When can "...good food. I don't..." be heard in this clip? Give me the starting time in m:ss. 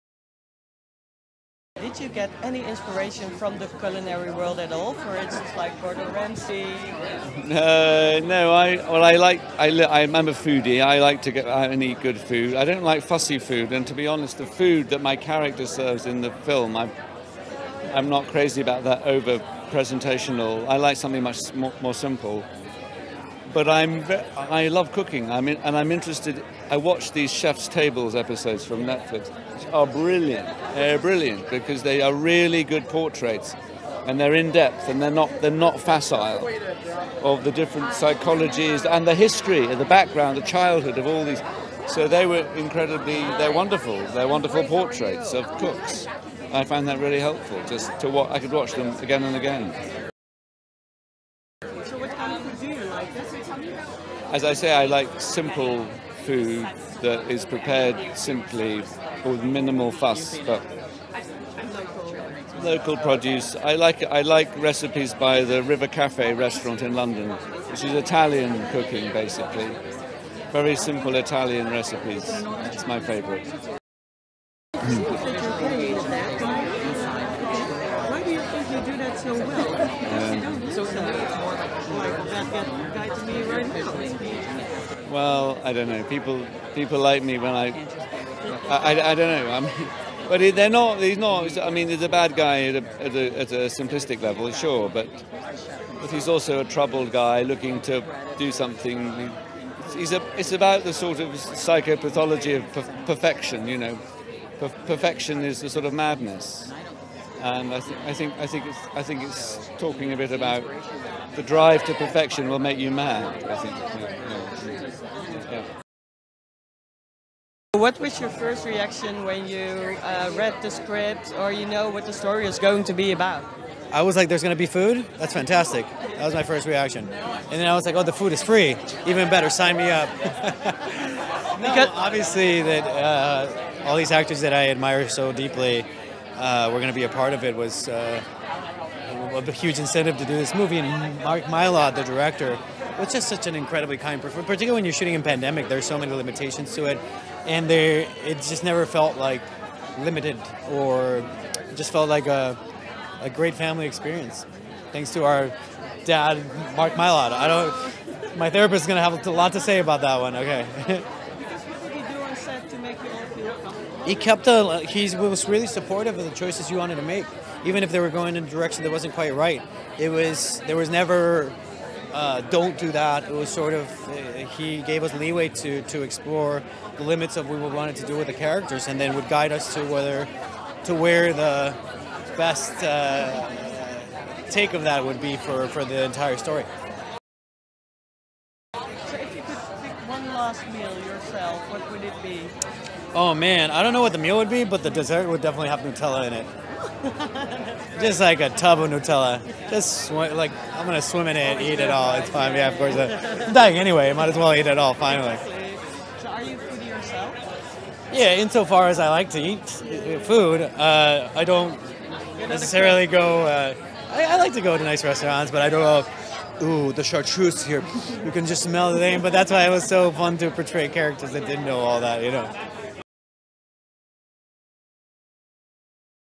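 0:12.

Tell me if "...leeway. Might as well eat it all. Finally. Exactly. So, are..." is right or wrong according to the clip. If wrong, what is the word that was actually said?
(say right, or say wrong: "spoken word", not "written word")
wrong: "anyway", not "leeway".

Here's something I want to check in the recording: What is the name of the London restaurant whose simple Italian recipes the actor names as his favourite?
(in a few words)
River Cafe.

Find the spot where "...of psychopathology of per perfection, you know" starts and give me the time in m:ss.
1:41.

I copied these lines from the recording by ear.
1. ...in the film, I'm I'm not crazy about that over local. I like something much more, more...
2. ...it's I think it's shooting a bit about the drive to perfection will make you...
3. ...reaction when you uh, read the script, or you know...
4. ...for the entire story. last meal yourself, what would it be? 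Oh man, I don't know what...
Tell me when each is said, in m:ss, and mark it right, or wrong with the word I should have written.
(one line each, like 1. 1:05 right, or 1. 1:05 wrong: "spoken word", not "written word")
1. 0:16 wrong: "presentational", not "local"
2. 1:48 wrong: "talking", not "shooting"
3. 1:58 right
4. 3:05 right.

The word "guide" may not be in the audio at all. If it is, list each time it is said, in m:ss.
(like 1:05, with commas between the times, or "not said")
2:59.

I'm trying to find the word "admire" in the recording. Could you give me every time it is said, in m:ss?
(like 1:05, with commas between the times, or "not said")
2:14.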